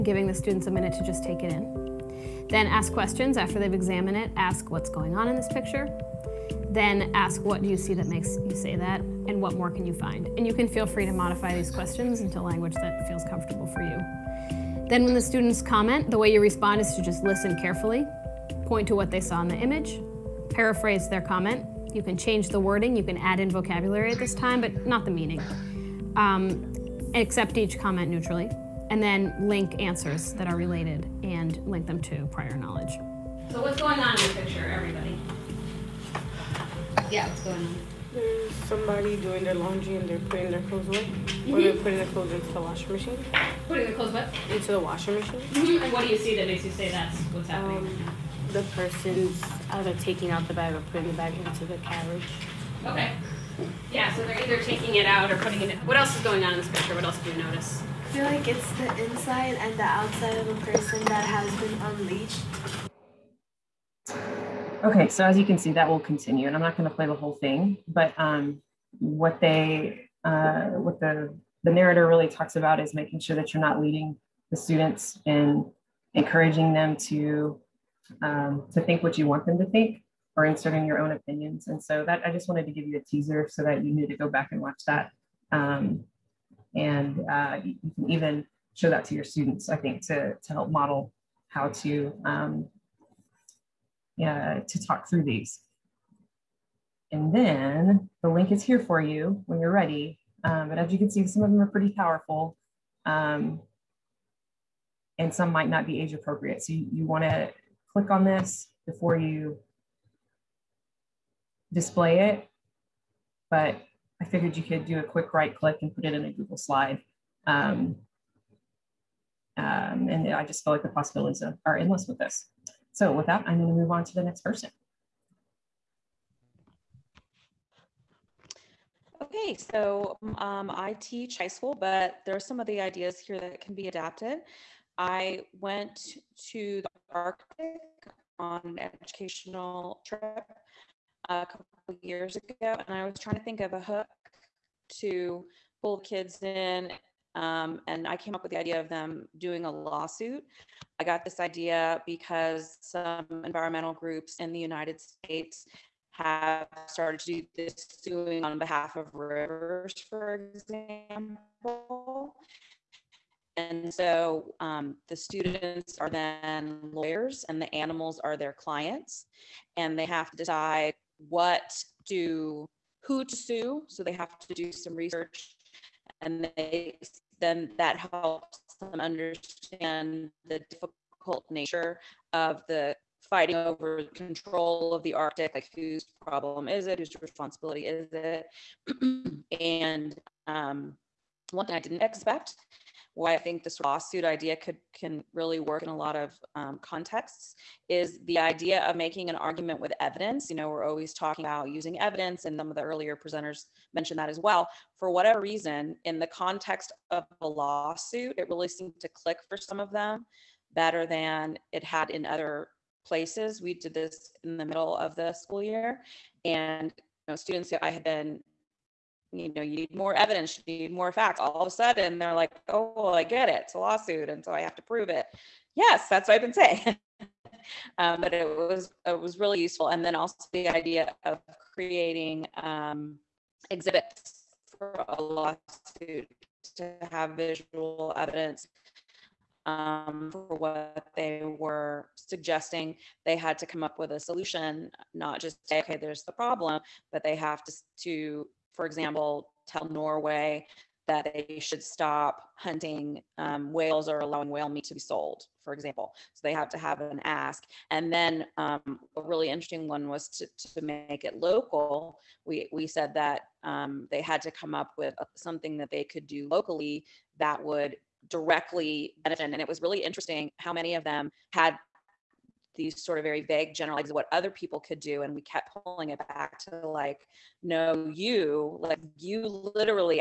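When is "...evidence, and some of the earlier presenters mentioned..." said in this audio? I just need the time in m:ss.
3:21.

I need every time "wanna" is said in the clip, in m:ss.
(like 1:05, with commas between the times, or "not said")
1:47.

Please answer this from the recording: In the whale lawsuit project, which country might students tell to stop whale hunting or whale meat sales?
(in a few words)
Norway.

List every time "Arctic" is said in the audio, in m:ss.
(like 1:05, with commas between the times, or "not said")
2:17, 3:05.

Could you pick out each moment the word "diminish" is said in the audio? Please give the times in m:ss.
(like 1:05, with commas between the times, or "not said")
not said.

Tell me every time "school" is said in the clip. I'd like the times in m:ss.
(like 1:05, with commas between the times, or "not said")
2:11, 3:35.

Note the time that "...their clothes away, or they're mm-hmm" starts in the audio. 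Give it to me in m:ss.
0:40.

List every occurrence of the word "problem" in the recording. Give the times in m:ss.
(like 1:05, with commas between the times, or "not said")
3:06, 4:06.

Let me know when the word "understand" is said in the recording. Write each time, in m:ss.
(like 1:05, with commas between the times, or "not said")
2:58.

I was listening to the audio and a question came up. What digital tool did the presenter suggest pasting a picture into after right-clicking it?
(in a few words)
Google slide.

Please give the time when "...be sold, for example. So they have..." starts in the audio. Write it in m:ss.
4:14.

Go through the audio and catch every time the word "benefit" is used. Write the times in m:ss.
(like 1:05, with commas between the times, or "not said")
4:29.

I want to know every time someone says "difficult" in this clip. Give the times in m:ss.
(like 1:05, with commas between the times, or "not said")
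3:00.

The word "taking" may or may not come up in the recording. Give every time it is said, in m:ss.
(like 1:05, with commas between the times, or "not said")
0:49, 0:54.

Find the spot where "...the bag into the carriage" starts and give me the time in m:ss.
0:51.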